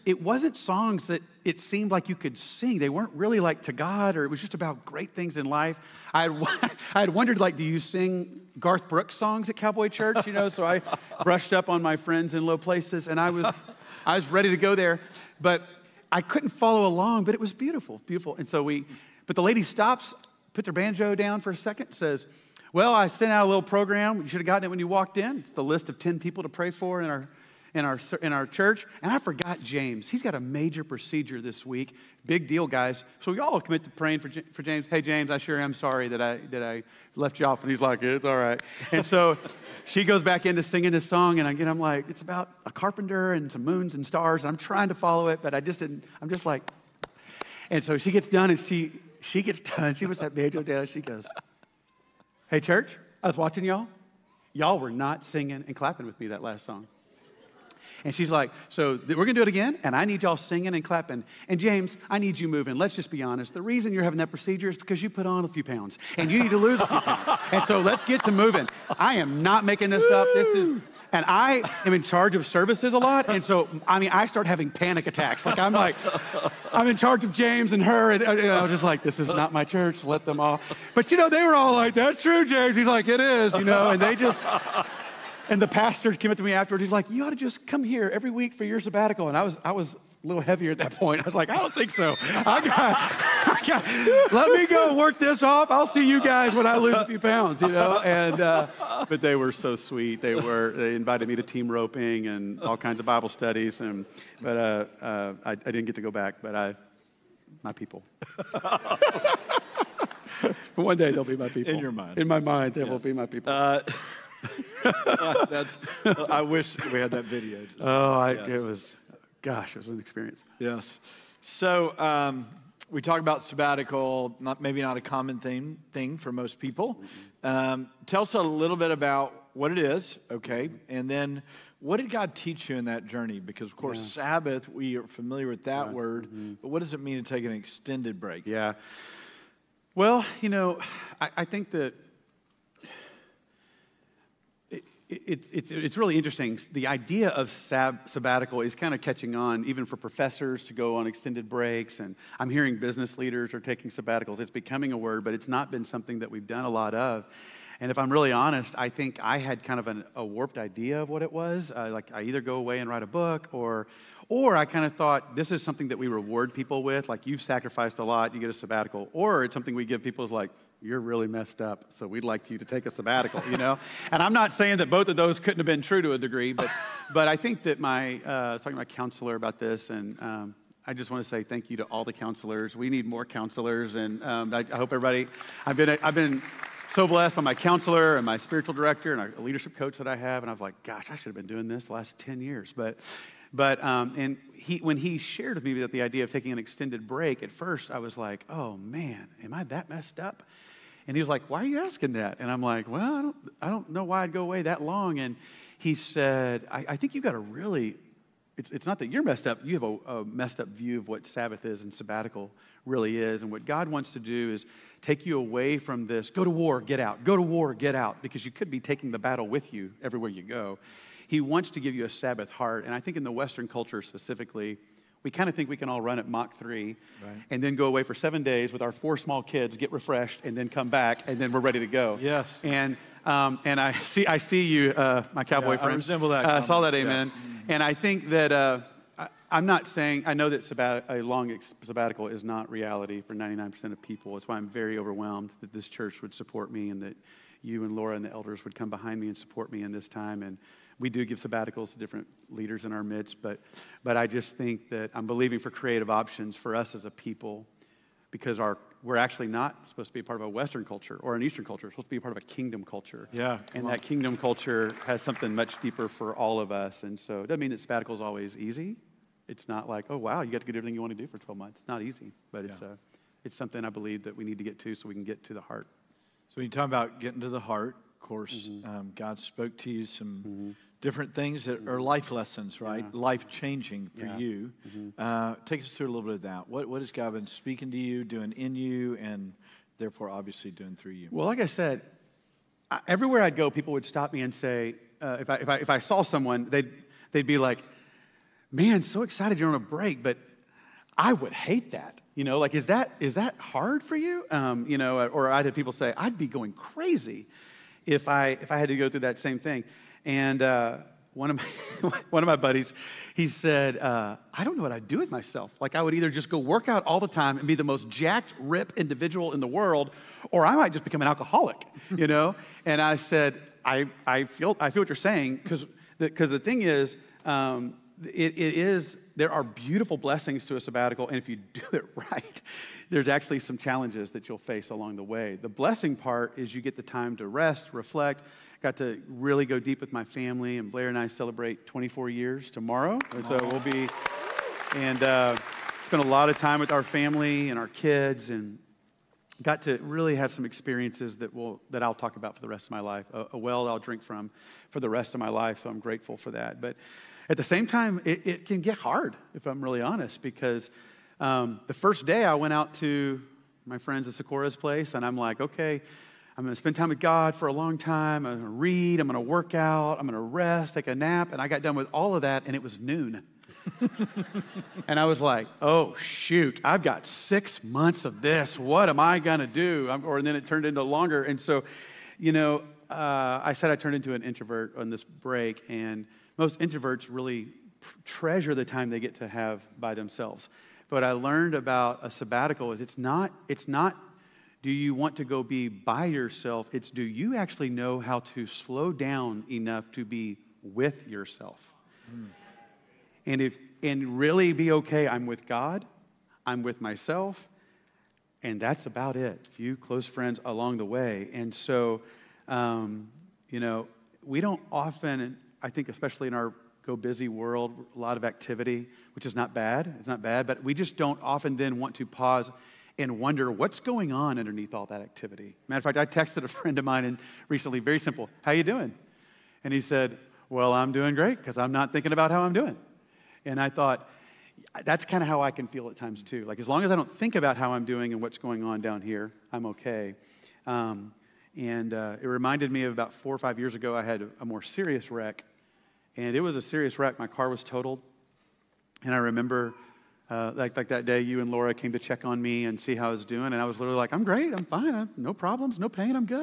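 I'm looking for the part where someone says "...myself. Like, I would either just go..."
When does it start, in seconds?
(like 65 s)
315 s.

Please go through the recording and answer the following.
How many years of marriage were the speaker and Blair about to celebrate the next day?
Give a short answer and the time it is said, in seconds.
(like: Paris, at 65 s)
24 years, at 341 s.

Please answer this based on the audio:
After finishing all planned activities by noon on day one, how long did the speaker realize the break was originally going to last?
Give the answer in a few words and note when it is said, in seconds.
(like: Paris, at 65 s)
six months, at 377 s.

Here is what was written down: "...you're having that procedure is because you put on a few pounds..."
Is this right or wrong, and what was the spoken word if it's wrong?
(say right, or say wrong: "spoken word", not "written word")
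right.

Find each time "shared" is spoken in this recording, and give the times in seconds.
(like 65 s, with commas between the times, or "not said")
195 s.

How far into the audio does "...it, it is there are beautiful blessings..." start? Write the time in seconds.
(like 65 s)
328 s.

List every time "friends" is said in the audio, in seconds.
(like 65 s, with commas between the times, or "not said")
11 s, 235 s, 363 s, 410 s, 426 s.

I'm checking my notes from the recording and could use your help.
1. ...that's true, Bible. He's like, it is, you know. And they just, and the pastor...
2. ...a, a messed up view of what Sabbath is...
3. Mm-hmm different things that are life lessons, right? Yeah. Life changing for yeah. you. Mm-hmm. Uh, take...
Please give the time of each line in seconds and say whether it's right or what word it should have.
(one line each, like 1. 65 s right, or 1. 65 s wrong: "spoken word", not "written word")
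1. 81 s wrong: "James", not "Bible"
2. 209 s right
3. 280 s right.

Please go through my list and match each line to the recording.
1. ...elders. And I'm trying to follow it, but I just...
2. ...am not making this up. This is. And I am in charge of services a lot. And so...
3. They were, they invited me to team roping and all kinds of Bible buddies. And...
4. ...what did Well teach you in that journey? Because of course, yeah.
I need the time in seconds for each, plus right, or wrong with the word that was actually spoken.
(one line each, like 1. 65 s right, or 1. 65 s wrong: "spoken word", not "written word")
1. 44 s wrong: "stars", not "elders"
2. 69 s right
3. 100 s wrong: "studies", not "buddies"
4. 131 s wrong: "God", not "Well".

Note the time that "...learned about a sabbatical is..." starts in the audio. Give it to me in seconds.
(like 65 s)
391 s.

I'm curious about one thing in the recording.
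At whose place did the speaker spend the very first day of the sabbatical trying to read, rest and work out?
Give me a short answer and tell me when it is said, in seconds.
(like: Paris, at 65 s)
Sakura's, at 364 s.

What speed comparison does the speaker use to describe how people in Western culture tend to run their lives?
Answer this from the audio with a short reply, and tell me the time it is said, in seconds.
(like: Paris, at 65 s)
Mach 3, at 226 s.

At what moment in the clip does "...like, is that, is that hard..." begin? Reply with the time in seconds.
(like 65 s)
302 s.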